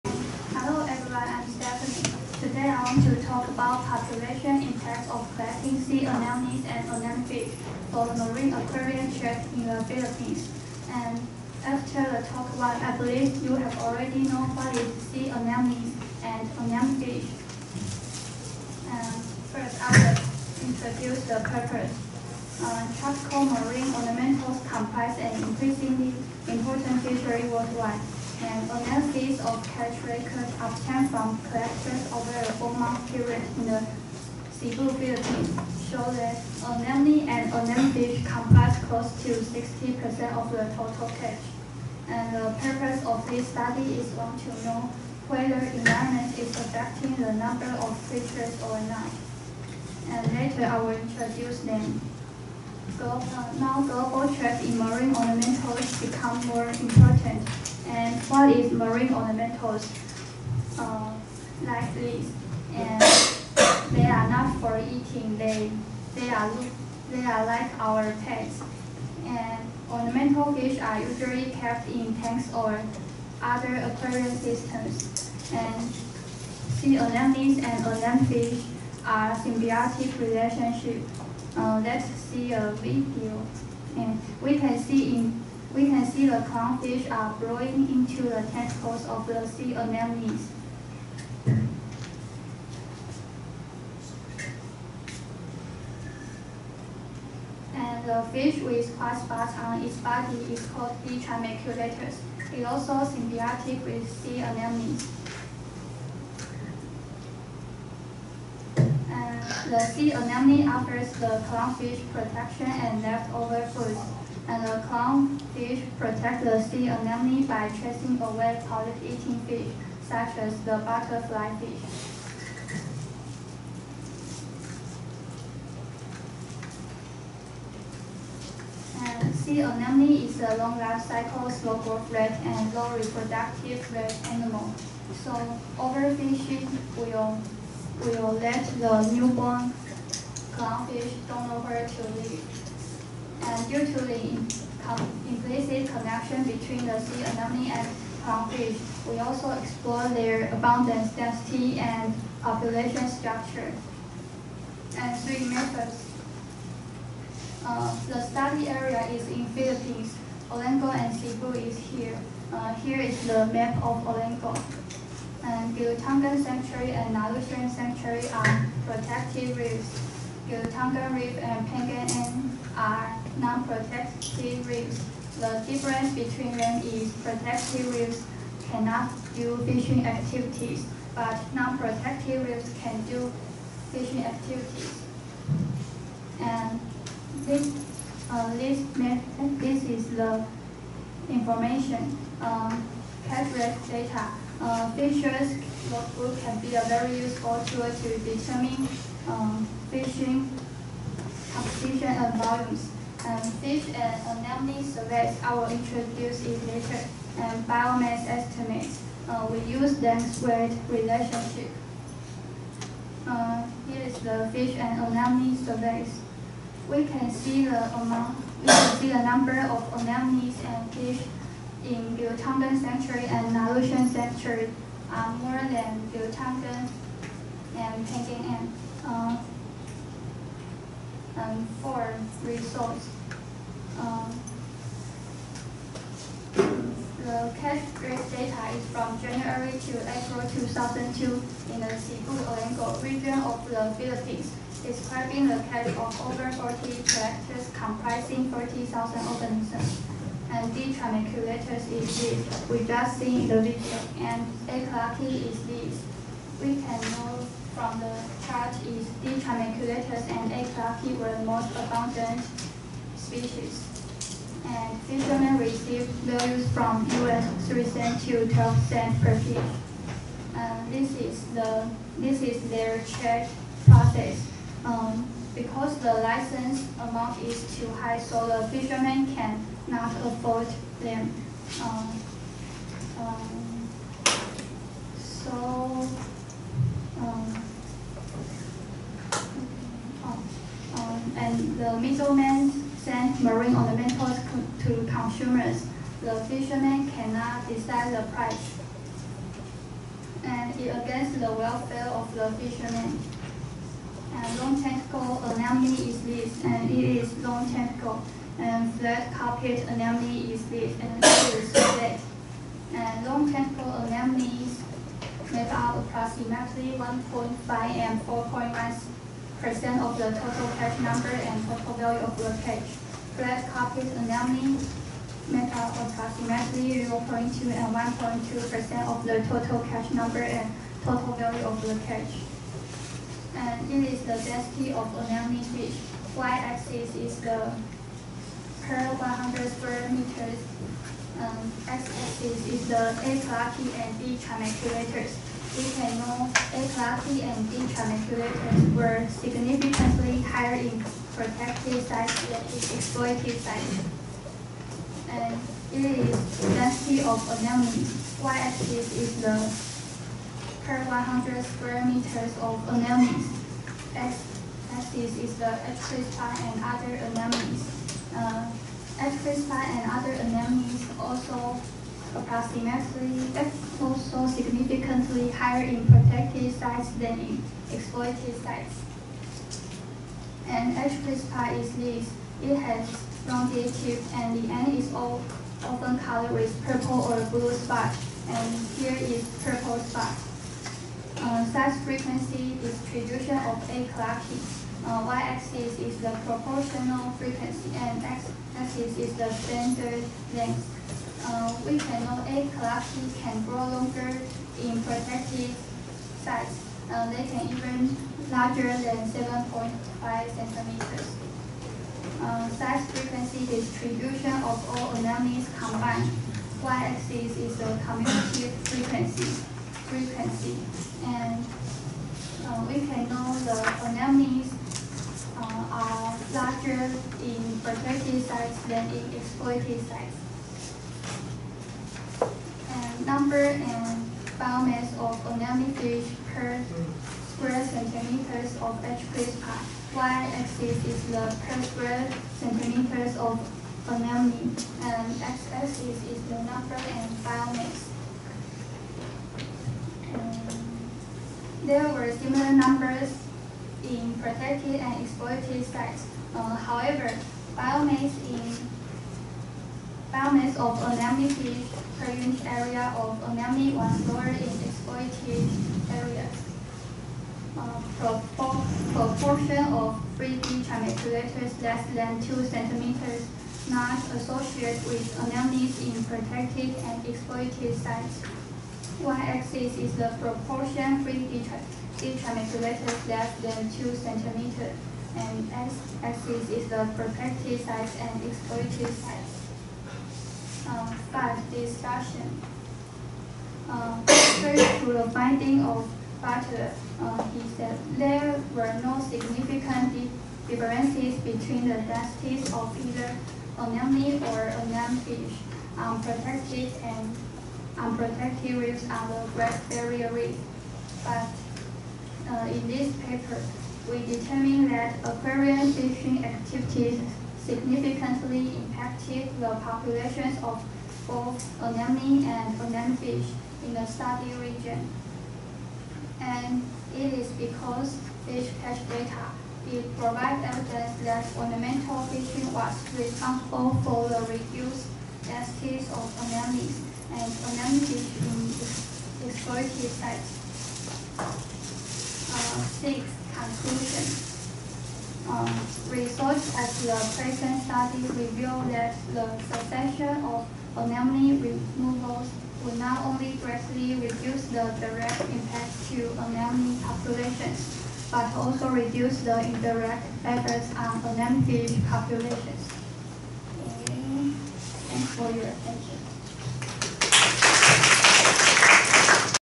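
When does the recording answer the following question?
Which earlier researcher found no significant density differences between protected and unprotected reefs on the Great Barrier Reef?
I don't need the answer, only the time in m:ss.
8:16.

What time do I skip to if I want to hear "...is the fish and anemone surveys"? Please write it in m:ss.
3:34.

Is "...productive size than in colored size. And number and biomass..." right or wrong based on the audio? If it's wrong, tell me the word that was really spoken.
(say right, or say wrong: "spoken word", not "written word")
wrong: "exploited", not "colored".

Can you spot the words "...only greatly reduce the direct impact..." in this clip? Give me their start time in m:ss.
9:13.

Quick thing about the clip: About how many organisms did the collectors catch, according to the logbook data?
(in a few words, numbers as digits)
40,000.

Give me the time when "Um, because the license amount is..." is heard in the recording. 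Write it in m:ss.
4:34.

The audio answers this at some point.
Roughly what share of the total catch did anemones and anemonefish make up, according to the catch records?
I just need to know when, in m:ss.
0:39.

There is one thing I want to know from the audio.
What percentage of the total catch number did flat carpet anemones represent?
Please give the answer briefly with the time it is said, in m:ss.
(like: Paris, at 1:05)
0.2%, at 5:27.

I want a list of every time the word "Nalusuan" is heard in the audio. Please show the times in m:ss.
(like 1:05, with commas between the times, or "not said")
2:47, 3:43.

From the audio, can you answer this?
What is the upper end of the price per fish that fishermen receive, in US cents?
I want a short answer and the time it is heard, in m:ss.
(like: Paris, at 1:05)
12 cents, at 4:28.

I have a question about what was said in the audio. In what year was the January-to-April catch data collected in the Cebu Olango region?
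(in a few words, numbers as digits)
2002.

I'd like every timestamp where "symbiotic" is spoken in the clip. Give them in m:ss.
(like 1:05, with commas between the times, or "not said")
1:19, 1:43.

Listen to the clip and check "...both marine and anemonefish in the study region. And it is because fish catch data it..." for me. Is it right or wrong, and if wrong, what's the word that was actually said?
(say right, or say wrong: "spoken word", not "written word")
wrong: "anemone", not "marine".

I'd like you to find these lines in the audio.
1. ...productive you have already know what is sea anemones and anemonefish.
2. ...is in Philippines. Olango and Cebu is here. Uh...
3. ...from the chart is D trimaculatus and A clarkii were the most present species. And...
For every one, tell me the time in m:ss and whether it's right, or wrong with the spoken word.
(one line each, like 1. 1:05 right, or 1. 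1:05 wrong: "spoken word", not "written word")
1. 0:13 wrong: "believe", not "productive"
2. 2:39 right
3. 4:17 wrong: "abundant", not "present".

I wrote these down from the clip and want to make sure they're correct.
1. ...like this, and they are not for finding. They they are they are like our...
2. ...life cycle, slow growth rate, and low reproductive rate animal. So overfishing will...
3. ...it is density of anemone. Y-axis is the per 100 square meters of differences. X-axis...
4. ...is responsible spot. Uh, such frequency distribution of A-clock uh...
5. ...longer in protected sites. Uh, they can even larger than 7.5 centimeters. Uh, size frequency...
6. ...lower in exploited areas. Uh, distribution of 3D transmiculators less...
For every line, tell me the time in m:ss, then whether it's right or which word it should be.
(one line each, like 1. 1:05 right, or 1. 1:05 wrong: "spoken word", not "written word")
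1. 1:01 wrong: "eating", not "finding"
2. 2:10 right
3. 5:55 wrong: "anemones", not "differences"
4. 6:29 wrong: "purple", not "responsible"
5. 6:43 right
6. 7:44 wrong: "proportion", not "distribution".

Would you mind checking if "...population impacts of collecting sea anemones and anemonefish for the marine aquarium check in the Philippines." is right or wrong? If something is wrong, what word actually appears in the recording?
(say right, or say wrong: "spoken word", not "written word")
right.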